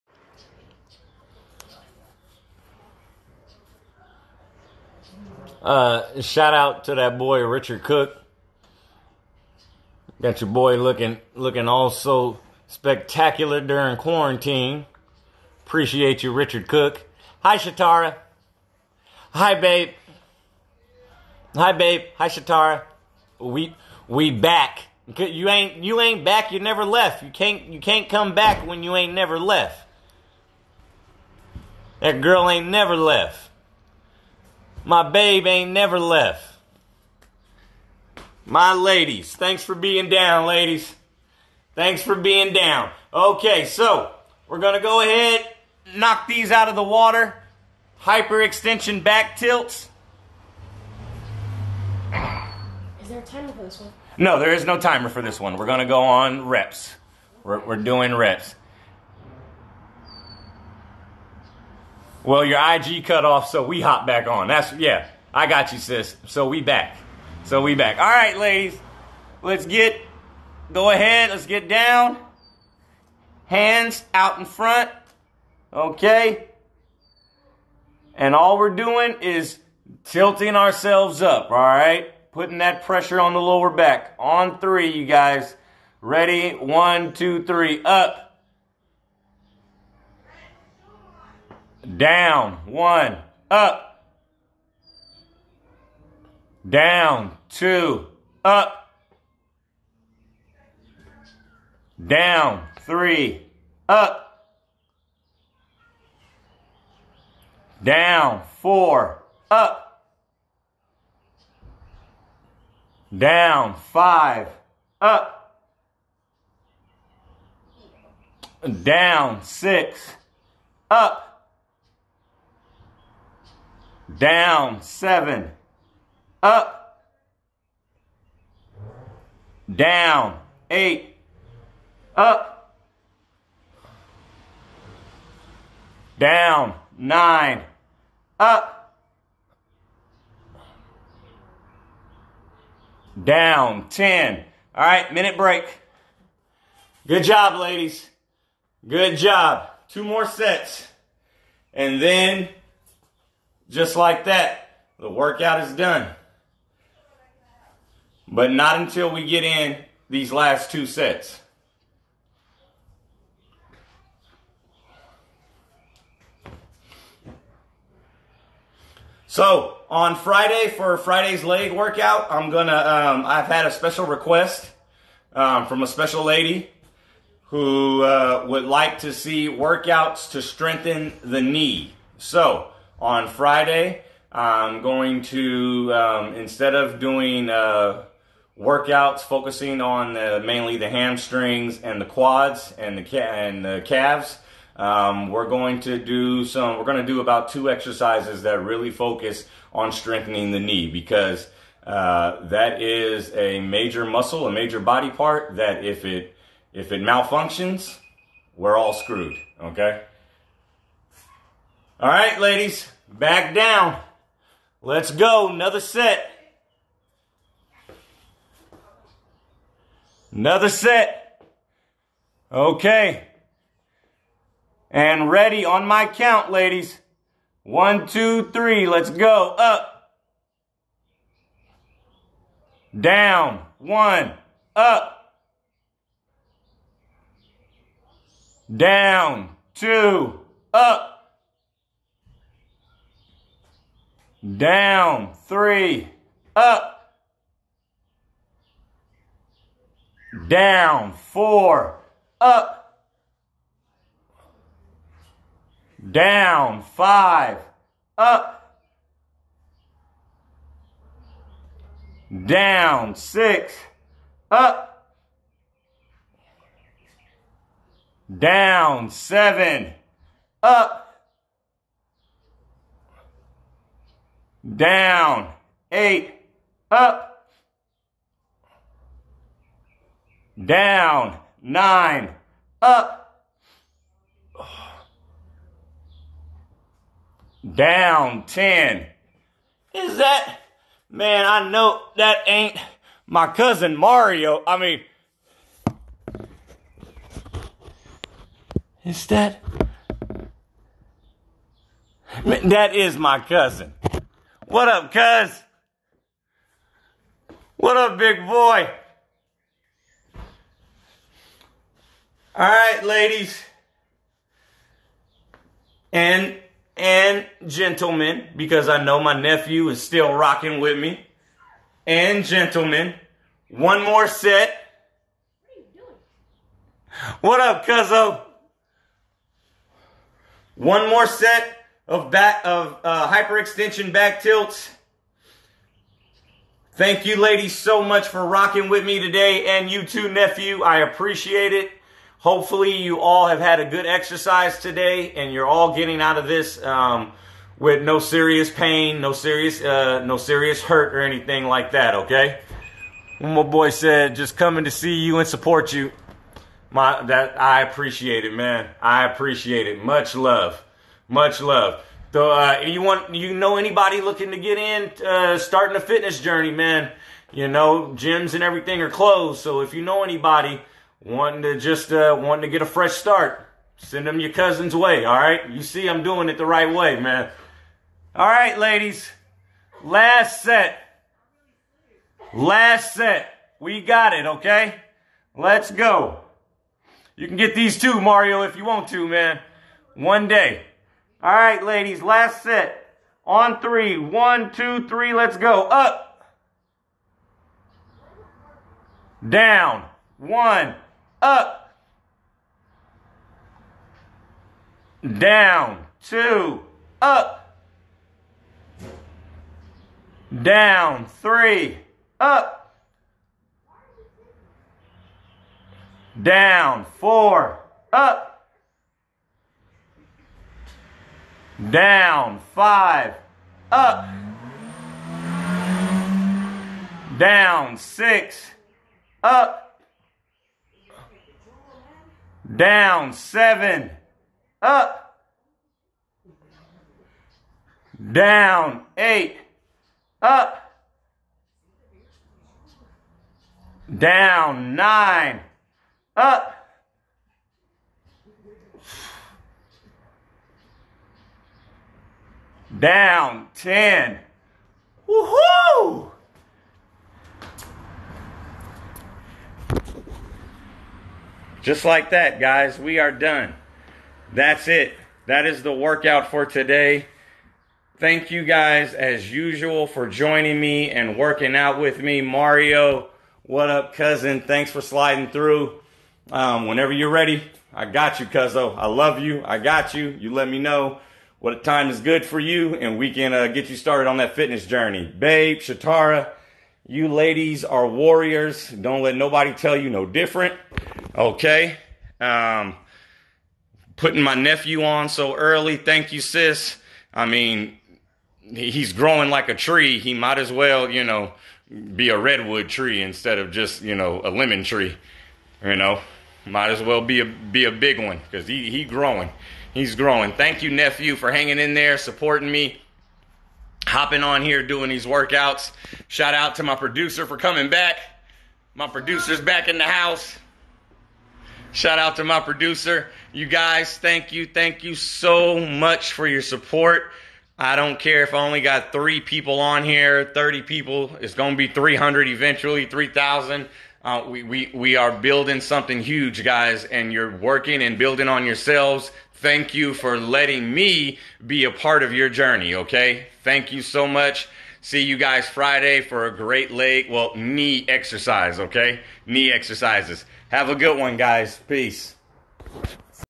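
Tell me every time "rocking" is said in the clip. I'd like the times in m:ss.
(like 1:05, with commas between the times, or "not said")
5:20, 5:38.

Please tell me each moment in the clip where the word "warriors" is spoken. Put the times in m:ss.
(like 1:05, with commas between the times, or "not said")
8:08.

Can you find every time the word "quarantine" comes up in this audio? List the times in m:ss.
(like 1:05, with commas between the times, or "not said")
0:13.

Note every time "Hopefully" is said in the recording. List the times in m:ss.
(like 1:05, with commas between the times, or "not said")
5:42.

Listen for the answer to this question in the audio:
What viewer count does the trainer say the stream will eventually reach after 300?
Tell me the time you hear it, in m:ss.
8:53.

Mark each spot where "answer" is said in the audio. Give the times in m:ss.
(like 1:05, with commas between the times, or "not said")
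not said.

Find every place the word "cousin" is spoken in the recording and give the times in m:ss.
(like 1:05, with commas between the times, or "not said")
4:53, 5:03, 6:14, 7:54.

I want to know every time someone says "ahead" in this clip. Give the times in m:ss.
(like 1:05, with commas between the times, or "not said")
0:45, 1:10.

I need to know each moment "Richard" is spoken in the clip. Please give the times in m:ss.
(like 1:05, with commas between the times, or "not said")
0:07, 0:16.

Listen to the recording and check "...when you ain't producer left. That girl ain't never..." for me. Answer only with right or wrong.
wrong.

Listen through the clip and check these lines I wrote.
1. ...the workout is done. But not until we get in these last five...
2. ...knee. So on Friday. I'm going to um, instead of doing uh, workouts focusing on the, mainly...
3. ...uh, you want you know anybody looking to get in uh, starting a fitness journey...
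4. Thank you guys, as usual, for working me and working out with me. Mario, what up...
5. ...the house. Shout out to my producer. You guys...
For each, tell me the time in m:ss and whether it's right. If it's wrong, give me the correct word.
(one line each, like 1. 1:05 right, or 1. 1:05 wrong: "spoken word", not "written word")
1. 2:34 wrong: "two", not "five"
2. 3:01 right
3. 6:02 right
4. 7:48 wrong: "joining", not "working"
5. 8:39 right.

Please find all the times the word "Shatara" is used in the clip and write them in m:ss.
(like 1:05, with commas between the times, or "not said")
0:17, 0:22, 8:05.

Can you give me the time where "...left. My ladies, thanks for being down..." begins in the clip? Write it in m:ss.
0:35.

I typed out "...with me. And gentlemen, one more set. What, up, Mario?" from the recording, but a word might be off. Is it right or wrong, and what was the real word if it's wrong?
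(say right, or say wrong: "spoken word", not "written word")
wrong: "Cuzzo", not "Mario".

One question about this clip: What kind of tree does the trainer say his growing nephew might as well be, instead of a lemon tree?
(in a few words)
Redwood tree.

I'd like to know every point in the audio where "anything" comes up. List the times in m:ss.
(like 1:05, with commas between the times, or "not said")
5:51.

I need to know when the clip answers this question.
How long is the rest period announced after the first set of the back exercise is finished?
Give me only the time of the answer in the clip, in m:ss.
2:25.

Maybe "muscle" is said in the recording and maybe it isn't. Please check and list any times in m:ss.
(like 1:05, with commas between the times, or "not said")
3:24.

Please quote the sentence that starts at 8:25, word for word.
You know, might as well be a be a big one because he he growing he's growing.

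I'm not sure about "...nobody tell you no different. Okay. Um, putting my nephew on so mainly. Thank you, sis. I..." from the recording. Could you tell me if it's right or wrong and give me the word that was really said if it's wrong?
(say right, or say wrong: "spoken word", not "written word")
wrong: "early", not "mainly".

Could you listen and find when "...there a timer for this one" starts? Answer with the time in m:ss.
0:53.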